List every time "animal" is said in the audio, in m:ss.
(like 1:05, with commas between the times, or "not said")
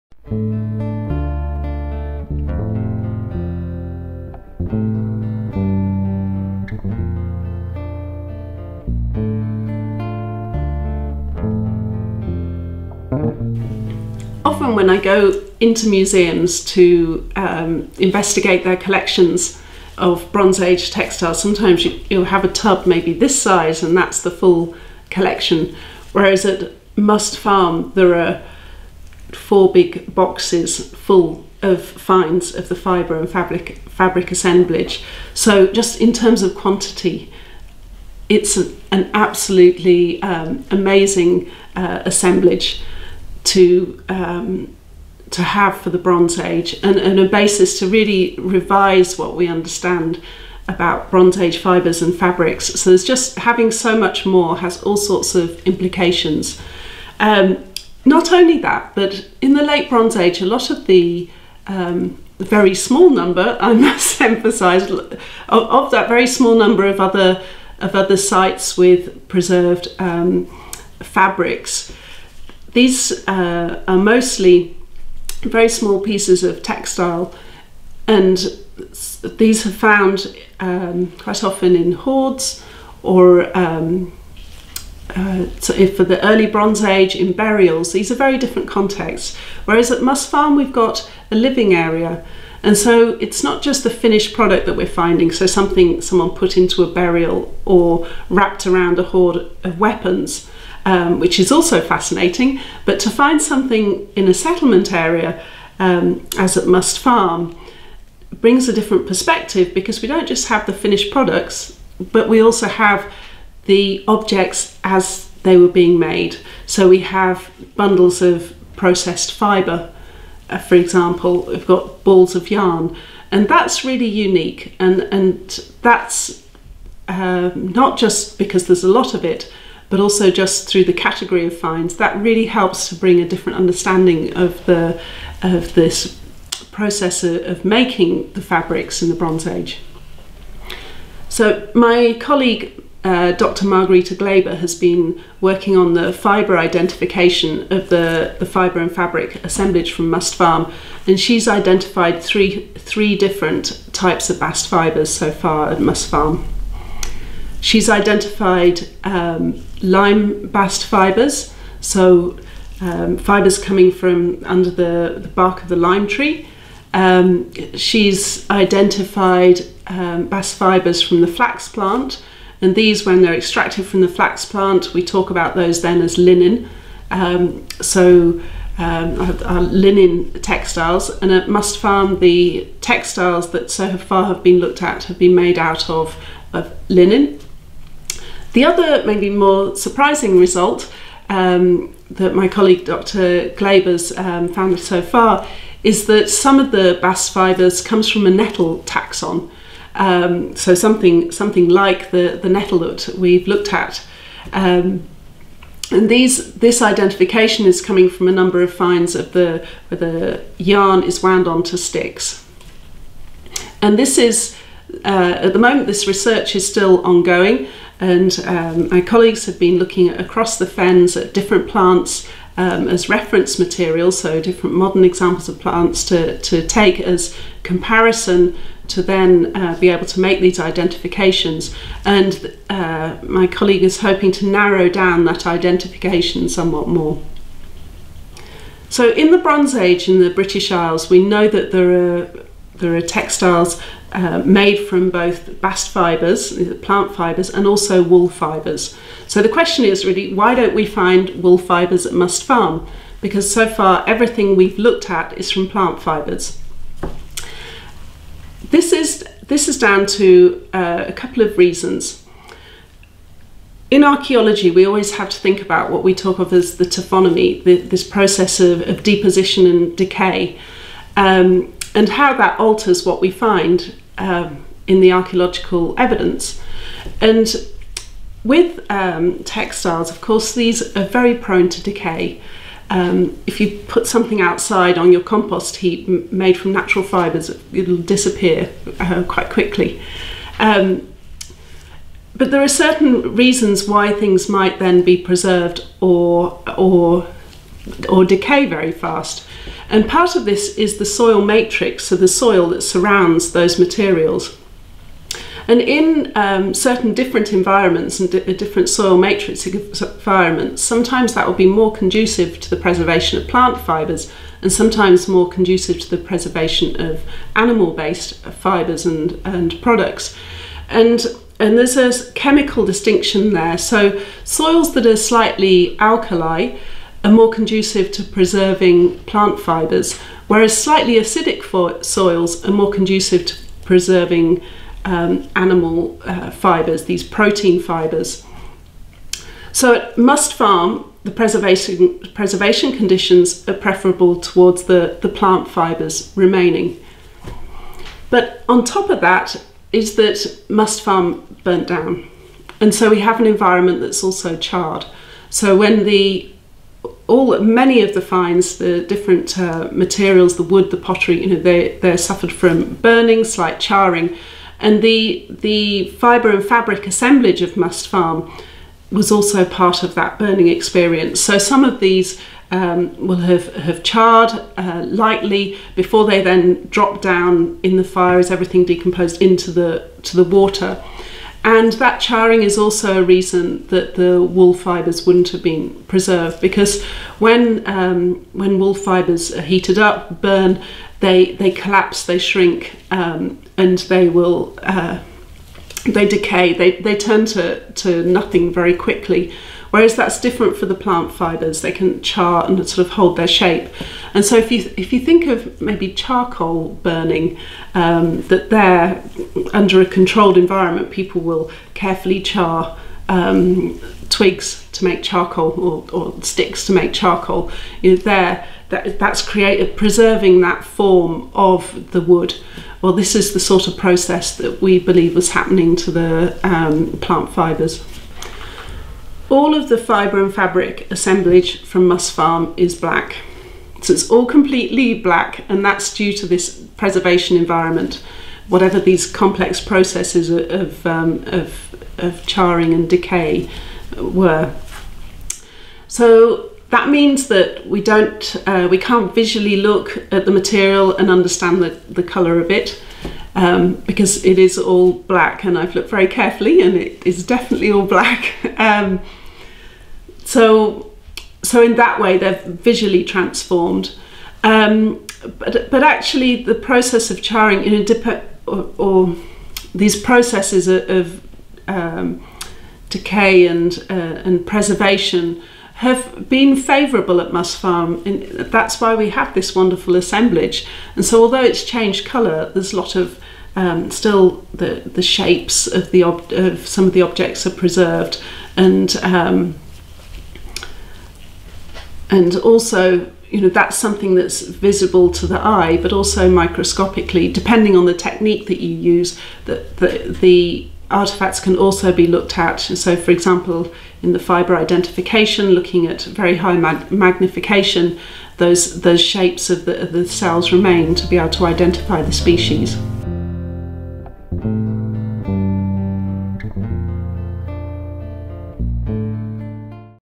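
5:17, 5:35.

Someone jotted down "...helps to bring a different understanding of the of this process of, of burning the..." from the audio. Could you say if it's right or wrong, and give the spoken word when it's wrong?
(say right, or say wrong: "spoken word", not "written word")
wrong: "making", not "burning".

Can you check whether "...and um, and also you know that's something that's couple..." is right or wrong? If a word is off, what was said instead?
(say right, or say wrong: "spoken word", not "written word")
wrong: "visible", not "couple".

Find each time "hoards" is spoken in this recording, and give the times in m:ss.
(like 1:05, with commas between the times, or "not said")
1:21, 1:39.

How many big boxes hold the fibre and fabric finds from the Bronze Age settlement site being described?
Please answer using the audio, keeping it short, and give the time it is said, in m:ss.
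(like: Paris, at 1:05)
4, at 0:29.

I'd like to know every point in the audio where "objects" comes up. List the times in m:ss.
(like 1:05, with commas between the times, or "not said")
1:54, 8:07.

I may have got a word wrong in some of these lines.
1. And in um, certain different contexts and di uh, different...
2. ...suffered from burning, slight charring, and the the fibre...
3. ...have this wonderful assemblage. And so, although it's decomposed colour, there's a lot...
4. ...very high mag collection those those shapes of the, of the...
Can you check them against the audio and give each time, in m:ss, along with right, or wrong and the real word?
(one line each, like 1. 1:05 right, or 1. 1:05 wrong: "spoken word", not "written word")
1. 5:05 wrong: "environments", not "contexts"
2. 6:02 right
3. 7:59 wrong: "changed", not "decomposed"
4. 8:26 wrong: "magnification", not "collection".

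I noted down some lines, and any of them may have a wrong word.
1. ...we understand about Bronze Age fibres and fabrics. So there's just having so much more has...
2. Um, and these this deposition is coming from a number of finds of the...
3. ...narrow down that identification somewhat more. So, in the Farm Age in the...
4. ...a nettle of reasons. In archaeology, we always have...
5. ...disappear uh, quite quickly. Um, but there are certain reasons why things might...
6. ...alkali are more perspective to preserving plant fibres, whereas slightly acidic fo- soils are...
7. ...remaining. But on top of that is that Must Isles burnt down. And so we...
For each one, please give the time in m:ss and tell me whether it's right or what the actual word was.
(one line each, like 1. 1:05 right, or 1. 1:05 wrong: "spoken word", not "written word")
1. 0:49 right
2. 3:24 wrong: "identification", not "deposition"
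3. 3:54 wrong: "Bronze", not "Farm"
4. 4:21 wrong: "couple", not "nettle"
5. 4:47 right
6. 5:25 wrong: "conducive", not "perspective"
7. 5:46 wrong: "Farm", not "Isles".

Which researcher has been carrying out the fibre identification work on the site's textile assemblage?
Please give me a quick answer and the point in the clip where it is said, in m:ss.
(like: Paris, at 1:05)
Dr. Margarita Gleba, at 2:23.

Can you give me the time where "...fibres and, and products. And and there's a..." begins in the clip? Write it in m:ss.
5:18.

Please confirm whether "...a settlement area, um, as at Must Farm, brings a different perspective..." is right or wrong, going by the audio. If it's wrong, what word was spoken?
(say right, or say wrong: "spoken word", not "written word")
right.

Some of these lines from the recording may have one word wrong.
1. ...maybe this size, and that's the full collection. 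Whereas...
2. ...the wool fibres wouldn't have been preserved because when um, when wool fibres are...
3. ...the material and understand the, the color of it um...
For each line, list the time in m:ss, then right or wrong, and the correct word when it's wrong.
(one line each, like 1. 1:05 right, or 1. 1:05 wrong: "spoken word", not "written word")
1. 0:22 right
2. 6:24 right
3. 7:30 right.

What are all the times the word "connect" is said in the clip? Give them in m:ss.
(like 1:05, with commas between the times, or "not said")
not said.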